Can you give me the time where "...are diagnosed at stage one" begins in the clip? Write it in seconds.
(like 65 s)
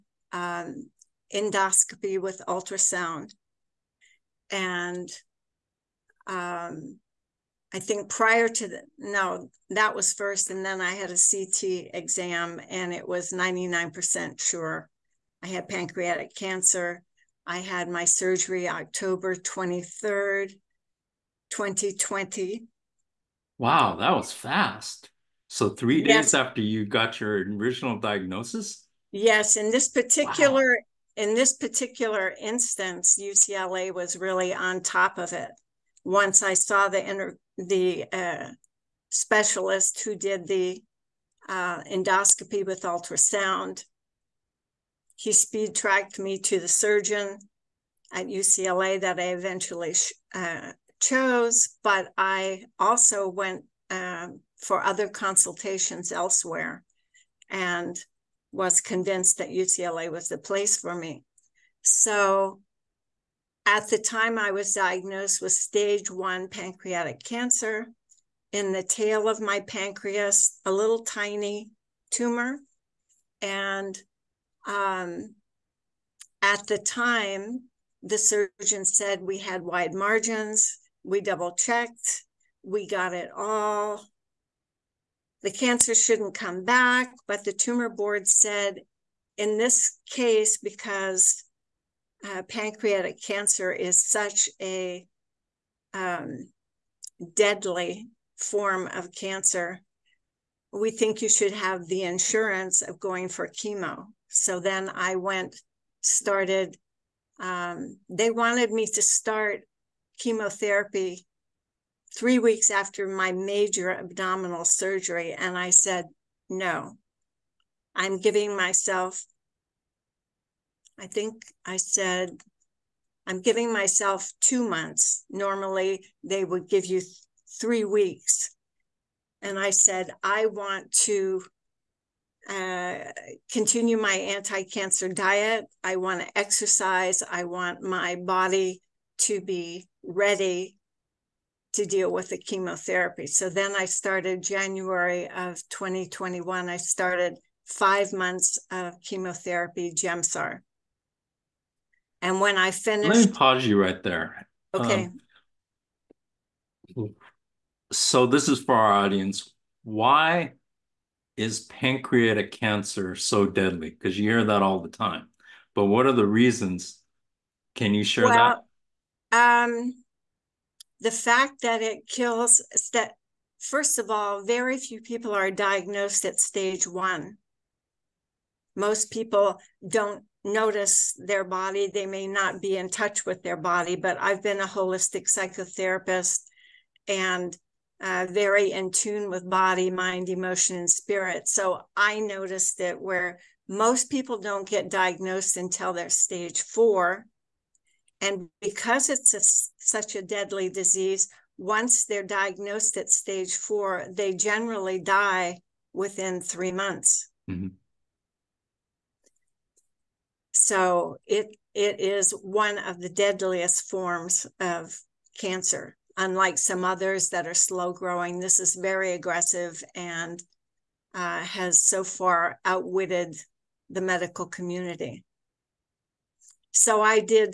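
175 s.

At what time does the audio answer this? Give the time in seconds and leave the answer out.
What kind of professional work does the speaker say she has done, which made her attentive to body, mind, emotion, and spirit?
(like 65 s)
184 s.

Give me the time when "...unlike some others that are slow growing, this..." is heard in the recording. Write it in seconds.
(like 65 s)
216 s.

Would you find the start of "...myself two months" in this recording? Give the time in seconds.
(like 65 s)
123 s.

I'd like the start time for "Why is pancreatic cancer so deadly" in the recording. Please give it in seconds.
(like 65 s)
159 s.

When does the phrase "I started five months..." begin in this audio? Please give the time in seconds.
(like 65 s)
146 s.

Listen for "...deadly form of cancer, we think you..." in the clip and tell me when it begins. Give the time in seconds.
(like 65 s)
97 s.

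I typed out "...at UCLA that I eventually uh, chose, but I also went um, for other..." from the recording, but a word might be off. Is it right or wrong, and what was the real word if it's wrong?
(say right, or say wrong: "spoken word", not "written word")
right.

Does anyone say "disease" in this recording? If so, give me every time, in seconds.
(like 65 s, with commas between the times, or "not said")
200 s.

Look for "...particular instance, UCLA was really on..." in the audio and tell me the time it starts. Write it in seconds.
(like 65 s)
31 s.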